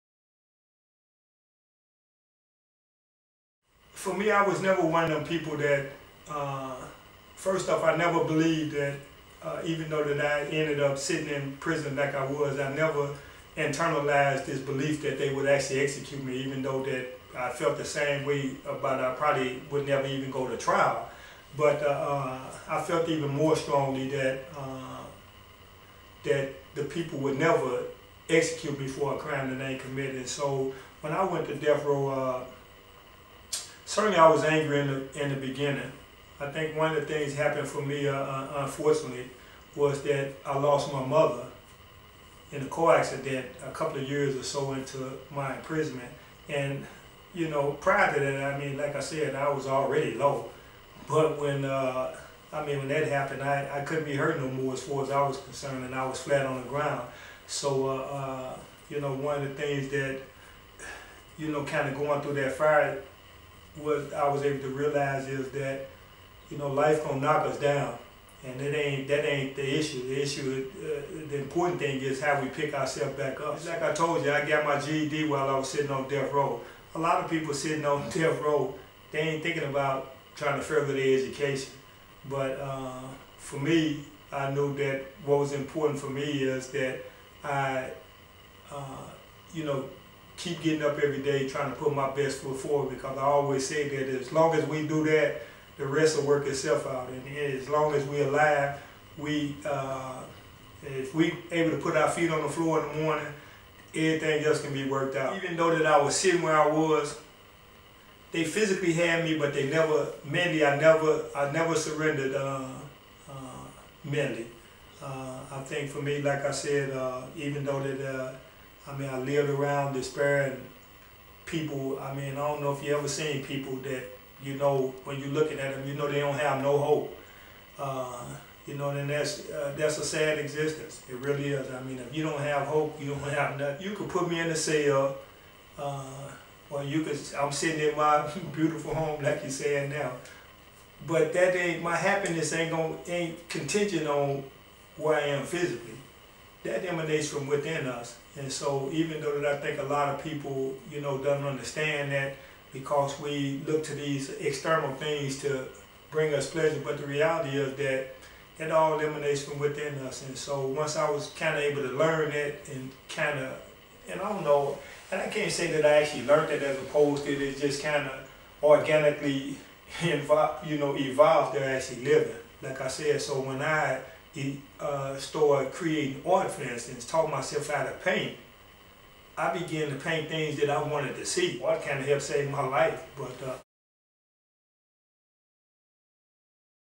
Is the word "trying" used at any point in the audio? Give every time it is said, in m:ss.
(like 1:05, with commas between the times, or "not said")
1:20, 1:31.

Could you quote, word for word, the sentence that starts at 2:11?
I mean, if you don't have hope, you don't have nothing.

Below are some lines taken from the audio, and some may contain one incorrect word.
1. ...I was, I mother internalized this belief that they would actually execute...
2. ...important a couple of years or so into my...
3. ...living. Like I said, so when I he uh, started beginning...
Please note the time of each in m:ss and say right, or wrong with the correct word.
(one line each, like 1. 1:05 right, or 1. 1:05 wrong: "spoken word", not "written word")
1. 0:12 wrong: "never", not "mother"
2. 0:42 wrong: "accident", not "important"
3. 2:52 wrong: "creating", not "beginning".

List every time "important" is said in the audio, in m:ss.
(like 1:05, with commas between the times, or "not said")
1:11, 1:25.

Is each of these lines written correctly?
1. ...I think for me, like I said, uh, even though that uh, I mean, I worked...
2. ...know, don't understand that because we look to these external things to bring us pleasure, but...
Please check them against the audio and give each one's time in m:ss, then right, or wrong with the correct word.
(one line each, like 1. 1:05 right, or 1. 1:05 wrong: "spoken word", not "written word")
1. 1:55 wrong: "lived", not "worked"
2. 2:31 right.